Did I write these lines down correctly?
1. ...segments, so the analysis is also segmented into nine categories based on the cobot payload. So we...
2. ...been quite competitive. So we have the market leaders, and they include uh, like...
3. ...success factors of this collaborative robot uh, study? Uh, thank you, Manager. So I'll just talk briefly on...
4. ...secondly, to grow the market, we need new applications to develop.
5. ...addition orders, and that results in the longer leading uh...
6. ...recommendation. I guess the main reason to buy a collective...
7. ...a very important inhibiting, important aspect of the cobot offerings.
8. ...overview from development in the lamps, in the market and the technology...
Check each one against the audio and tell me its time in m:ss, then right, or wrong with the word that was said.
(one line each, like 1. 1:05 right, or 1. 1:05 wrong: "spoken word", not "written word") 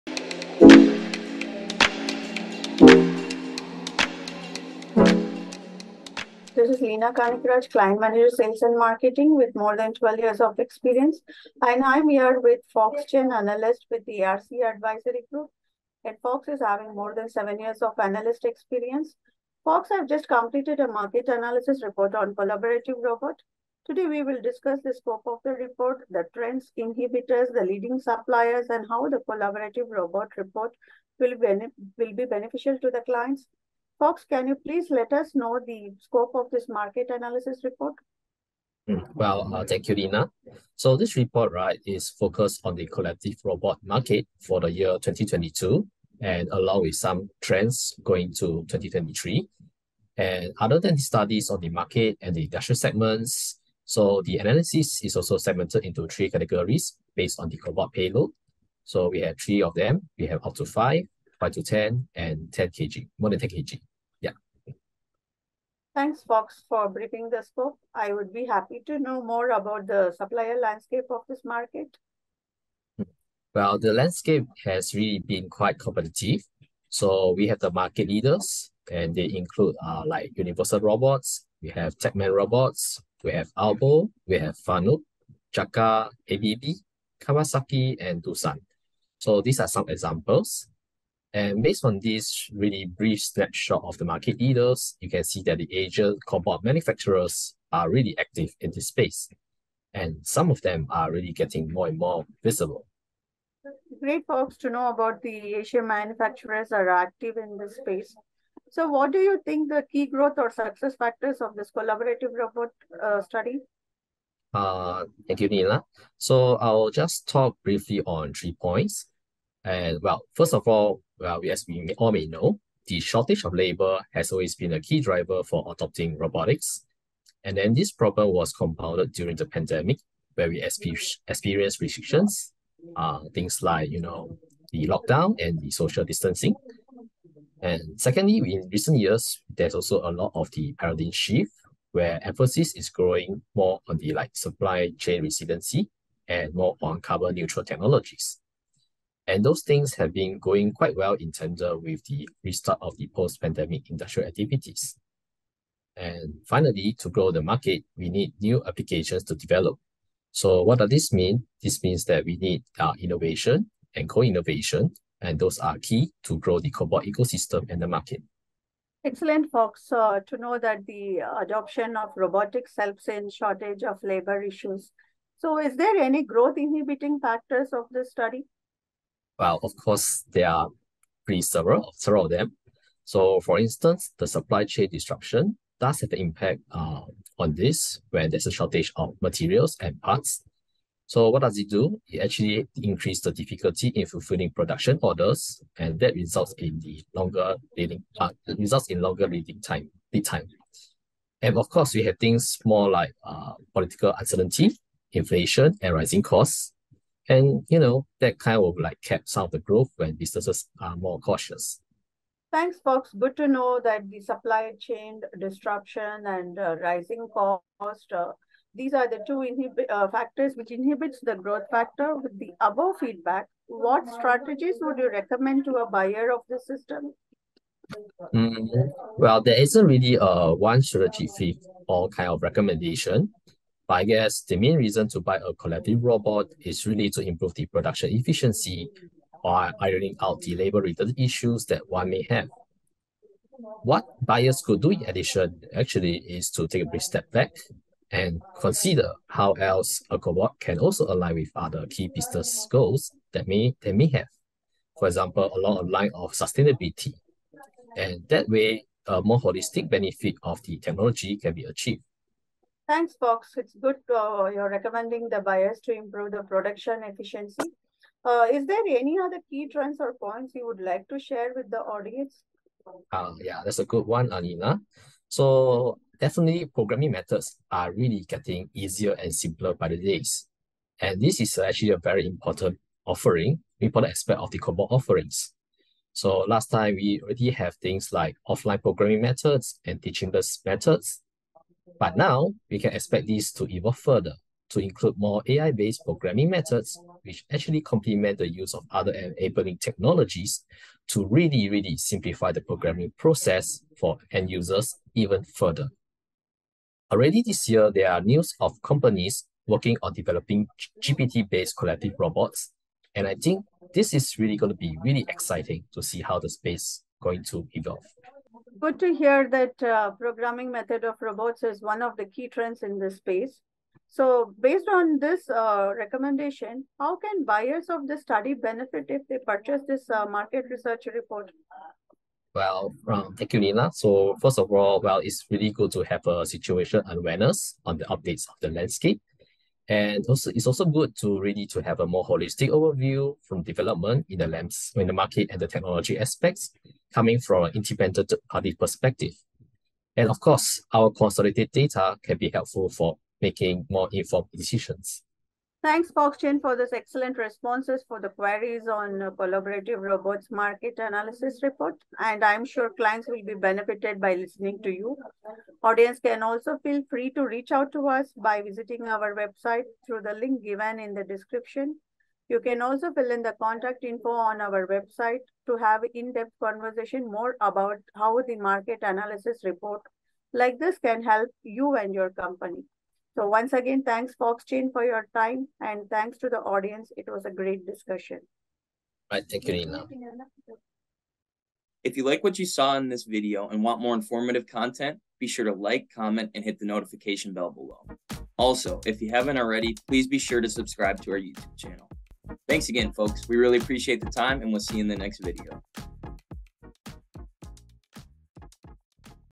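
1. 0:52 wrong: "three", not "nine"
2. 1:15 right
3. 1:50 wrong: "Nila", not "Manager"
4. 2:36 wrong: "finally", not "secondly"
5. 3:14 wrong: "production", not "addition"
6. 3:52 right
7. 4:41 wrong: "offering", not "inhibiting"
8. 5:42 right.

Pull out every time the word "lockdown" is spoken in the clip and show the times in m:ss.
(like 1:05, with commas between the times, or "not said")
2:14.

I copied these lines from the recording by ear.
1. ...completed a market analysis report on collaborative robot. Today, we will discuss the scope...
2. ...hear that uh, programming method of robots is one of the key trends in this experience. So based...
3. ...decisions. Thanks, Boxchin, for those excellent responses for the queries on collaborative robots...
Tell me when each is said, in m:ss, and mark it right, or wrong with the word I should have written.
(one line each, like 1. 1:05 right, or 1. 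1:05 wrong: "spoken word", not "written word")
1. 0:20 right
2. 5:19 wrong: "space", not "experience"
3. 5:54 right.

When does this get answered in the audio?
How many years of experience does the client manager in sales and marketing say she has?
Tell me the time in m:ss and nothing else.
0:09.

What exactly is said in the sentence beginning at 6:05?
Audience can also feel free to reach out to us by visiting our website through the link given in the description.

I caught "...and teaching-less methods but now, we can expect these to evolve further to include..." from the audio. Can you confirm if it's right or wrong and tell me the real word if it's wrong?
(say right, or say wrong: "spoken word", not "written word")
right.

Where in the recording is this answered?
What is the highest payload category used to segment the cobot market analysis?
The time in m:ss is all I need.
1:03.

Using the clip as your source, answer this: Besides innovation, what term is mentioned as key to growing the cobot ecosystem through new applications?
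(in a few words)
co-innovation.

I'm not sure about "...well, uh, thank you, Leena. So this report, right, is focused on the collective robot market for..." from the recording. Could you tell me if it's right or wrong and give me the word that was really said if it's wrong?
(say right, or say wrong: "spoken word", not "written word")
right.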